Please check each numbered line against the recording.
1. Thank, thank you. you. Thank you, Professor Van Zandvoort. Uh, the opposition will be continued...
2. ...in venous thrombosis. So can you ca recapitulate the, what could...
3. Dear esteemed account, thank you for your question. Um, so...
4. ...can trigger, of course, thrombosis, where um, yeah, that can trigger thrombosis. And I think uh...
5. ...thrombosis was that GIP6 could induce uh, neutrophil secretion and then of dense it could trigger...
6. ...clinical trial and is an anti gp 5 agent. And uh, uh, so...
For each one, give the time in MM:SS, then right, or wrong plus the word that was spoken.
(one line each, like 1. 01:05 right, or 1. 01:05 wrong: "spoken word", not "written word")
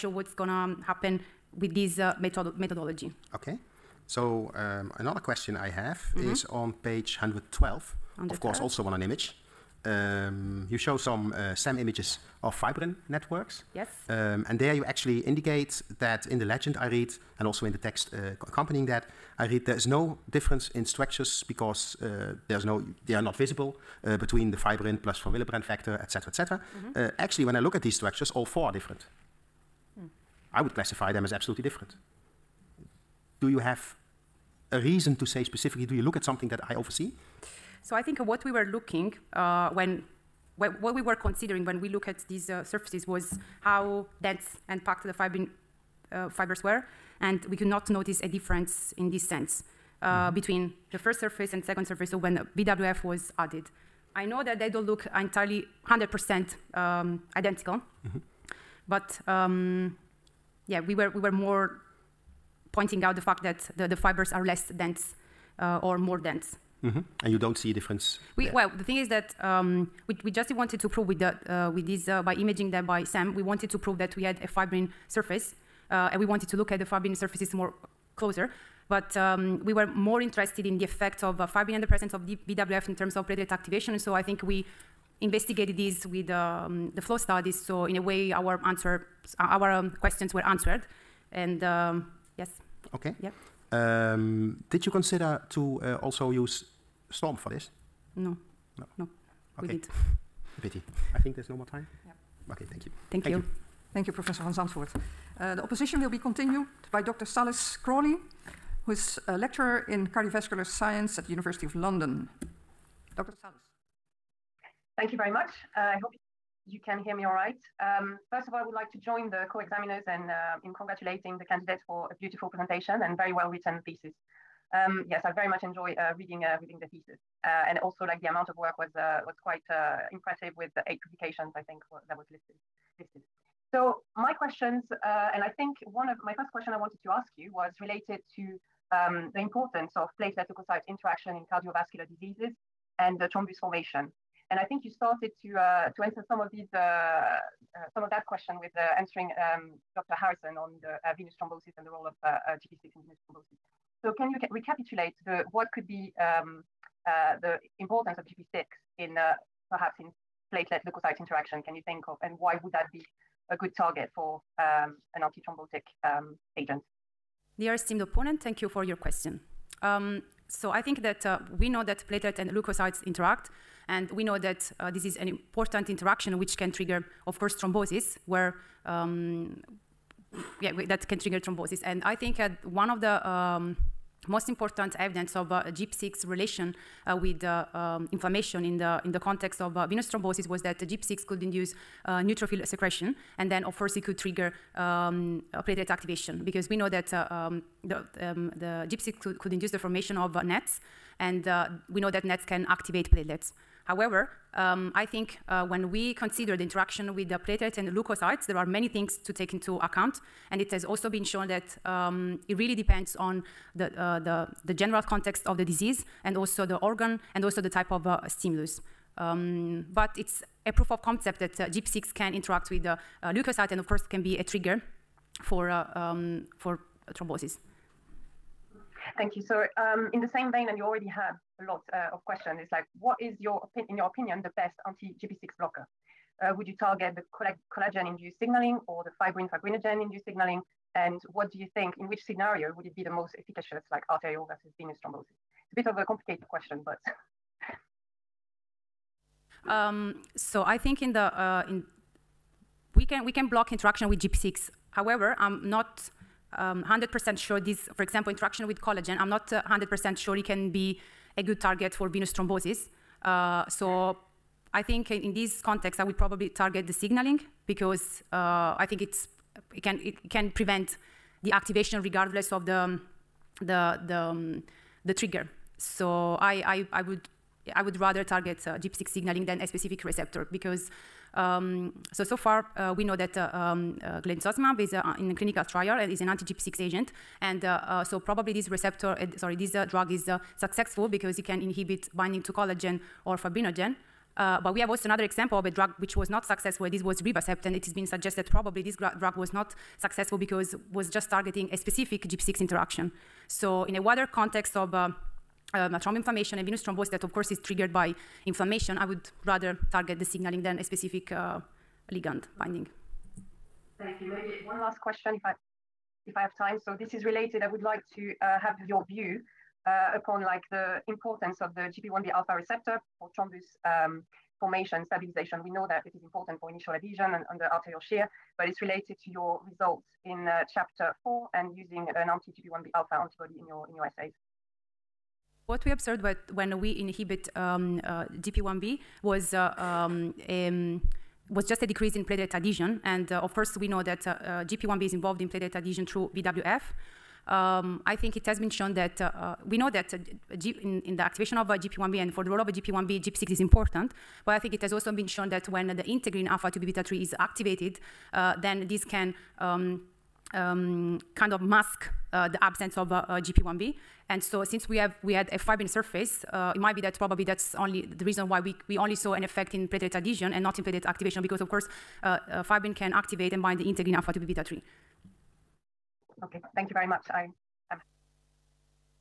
1. 01:43 right
2. 02:32 right
3. 02:47 wrong: "opponent", not "account"
4. 02:56 right
5. 03:10 wrong: "course", not "dense"
6. 04:45 wrong: "6", not "5".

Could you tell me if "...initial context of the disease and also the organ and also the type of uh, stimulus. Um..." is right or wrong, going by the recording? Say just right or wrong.
wrong.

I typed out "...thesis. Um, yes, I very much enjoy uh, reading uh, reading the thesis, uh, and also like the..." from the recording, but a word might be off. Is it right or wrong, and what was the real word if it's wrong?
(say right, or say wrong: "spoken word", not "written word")
right.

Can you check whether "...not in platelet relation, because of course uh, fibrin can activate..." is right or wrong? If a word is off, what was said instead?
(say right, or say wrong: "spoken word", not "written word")
wrong: "activation", not "relation".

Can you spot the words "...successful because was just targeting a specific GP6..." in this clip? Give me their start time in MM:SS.
04:59.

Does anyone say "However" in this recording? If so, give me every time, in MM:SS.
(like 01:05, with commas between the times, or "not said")
03:23, 04:14.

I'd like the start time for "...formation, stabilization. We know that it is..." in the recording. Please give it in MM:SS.
05:24.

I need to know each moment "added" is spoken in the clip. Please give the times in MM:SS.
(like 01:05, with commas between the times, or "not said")
00:53.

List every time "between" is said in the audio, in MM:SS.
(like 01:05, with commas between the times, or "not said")
00:24, 00:50.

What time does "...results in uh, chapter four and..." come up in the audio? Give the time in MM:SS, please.
05:29.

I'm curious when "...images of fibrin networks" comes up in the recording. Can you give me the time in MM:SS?
00:11.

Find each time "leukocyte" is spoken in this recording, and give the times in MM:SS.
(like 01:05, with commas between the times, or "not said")
02:20, 02:40, 02:52, 03:27, 03:43.